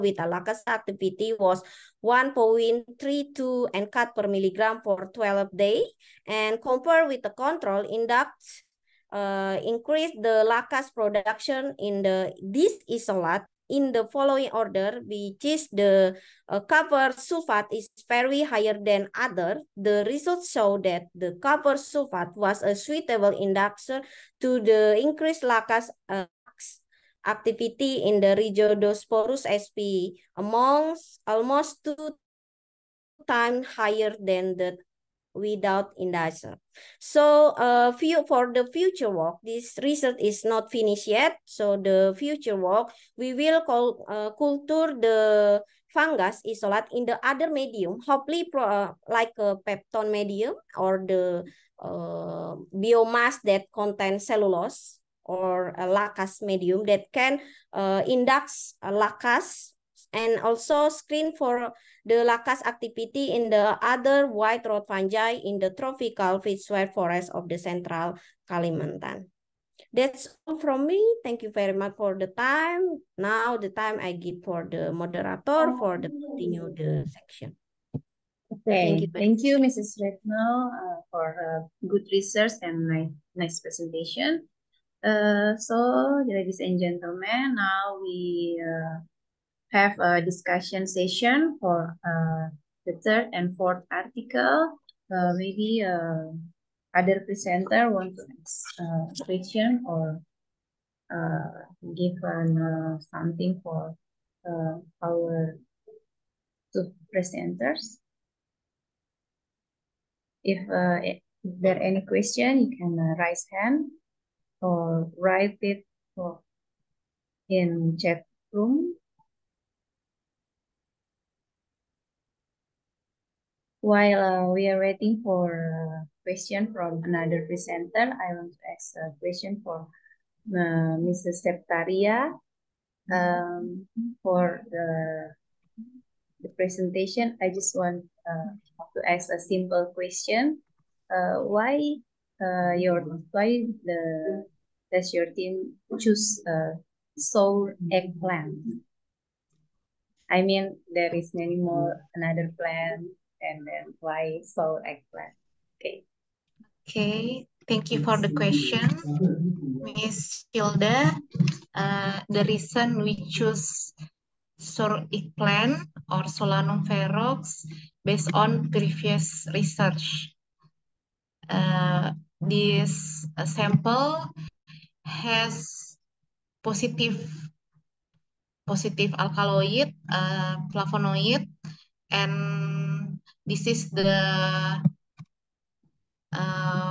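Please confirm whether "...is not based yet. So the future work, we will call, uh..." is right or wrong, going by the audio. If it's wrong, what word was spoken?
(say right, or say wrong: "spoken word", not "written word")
wrong: "finished", not "based".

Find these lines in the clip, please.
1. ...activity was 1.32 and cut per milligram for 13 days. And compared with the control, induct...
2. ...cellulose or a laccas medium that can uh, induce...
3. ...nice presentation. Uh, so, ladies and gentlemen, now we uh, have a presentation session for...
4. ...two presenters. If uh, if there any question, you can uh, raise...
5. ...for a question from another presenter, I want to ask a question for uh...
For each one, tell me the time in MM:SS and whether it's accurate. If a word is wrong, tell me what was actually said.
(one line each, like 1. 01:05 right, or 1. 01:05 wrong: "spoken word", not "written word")
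1. 00:00 wrong: "12", not "13"
2. 00:54 right
3. 01:23 wrong: "discussion", not "presentation"
4. 01:46 right
5. 02:05 right.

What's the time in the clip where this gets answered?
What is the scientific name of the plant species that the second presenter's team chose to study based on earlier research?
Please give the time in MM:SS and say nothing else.
02:46.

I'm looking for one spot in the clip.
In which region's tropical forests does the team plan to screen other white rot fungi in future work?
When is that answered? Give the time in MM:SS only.
01:07.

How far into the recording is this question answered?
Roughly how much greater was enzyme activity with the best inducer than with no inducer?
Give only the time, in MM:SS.
00:31.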